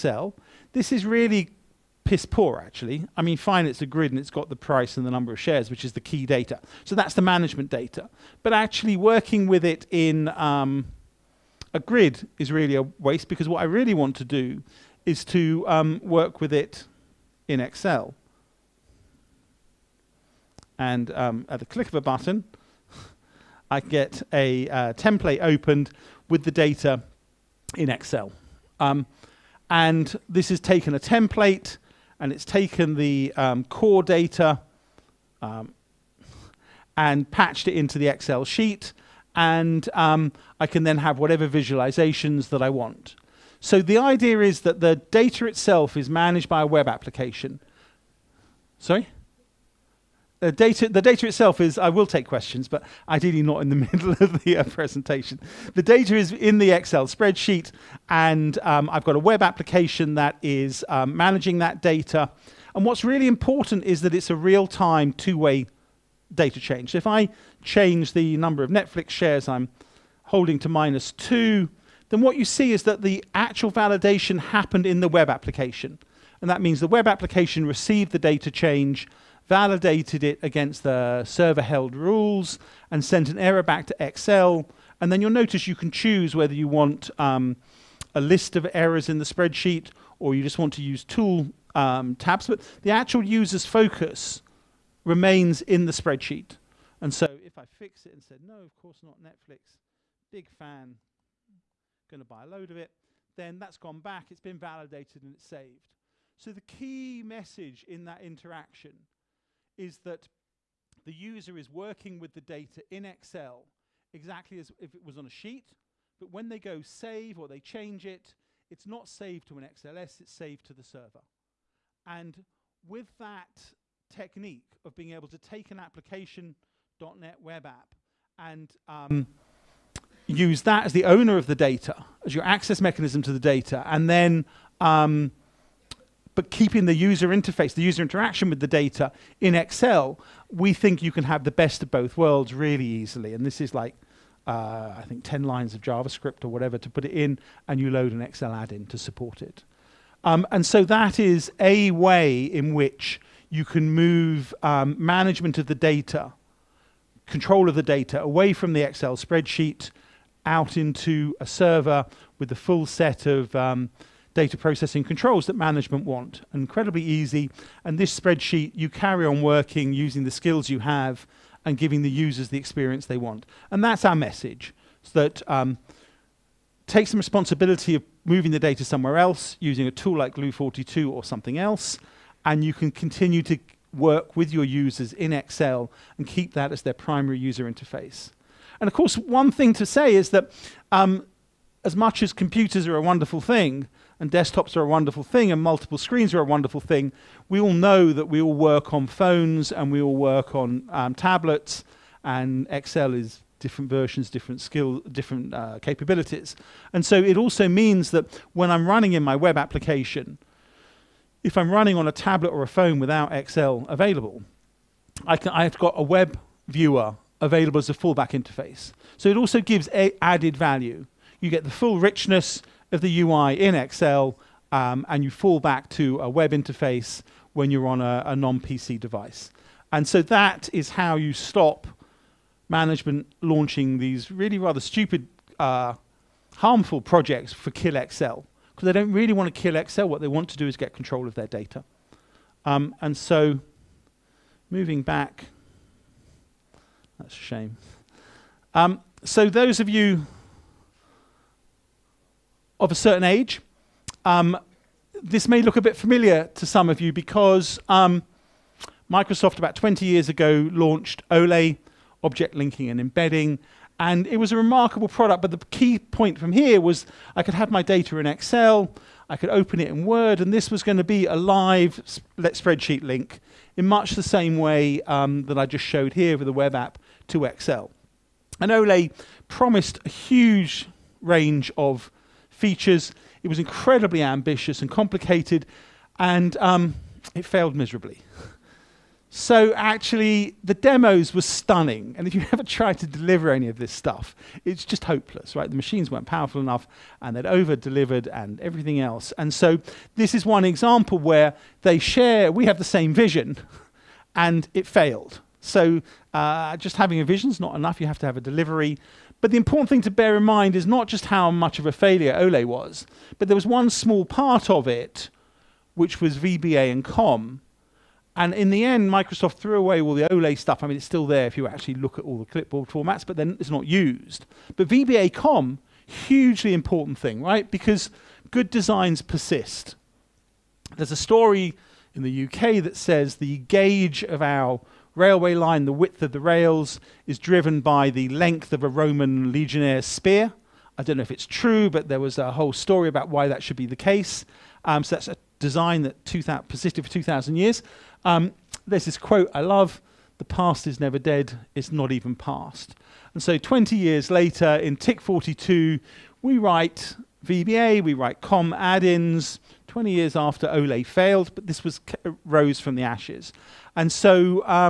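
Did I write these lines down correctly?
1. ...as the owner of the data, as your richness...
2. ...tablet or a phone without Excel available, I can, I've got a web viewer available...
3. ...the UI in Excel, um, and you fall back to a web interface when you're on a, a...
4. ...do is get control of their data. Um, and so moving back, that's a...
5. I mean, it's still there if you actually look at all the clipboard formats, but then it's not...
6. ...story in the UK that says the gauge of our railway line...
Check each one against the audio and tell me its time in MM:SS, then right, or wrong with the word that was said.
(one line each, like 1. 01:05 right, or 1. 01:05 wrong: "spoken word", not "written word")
1. 02:10 wrong: "access", not "richness"
2. 03:32 right
3. 03:43 right
4. 04:00 right
5. 05:20 right
6. 05:31 right.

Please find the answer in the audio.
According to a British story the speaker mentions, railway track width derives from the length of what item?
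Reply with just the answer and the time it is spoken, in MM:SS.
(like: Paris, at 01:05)
Roman legionnaire's spear, at 05:38.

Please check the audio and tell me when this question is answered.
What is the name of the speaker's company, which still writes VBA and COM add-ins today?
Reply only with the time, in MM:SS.
05:54.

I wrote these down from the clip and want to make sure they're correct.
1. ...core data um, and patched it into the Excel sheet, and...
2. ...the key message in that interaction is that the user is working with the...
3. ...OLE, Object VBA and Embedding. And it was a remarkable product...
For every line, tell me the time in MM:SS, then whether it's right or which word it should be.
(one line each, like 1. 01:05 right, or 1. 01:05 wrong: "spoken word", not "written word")
1. 00:33 right
2. 01:46 right
3. 04:21 wrong: "Linking", not "VBA".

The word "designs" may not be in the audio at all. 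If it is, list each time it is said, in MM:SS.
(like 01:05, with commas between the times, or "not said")
05:28, 05:45.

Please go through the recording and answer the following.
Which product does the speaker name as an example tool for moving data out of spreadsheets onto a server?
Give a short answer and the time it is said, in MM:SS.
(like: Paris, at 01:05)
Glue42, at 03:00.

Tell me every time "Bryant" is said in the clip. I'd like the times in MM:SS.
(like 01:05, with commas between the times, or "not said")
not said.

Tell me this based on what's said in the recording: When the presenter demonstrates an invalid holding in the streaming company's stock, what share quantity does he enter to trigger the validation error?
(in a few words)
-2.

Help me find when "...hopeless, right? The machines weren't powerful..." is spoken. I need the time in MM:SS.
04:55.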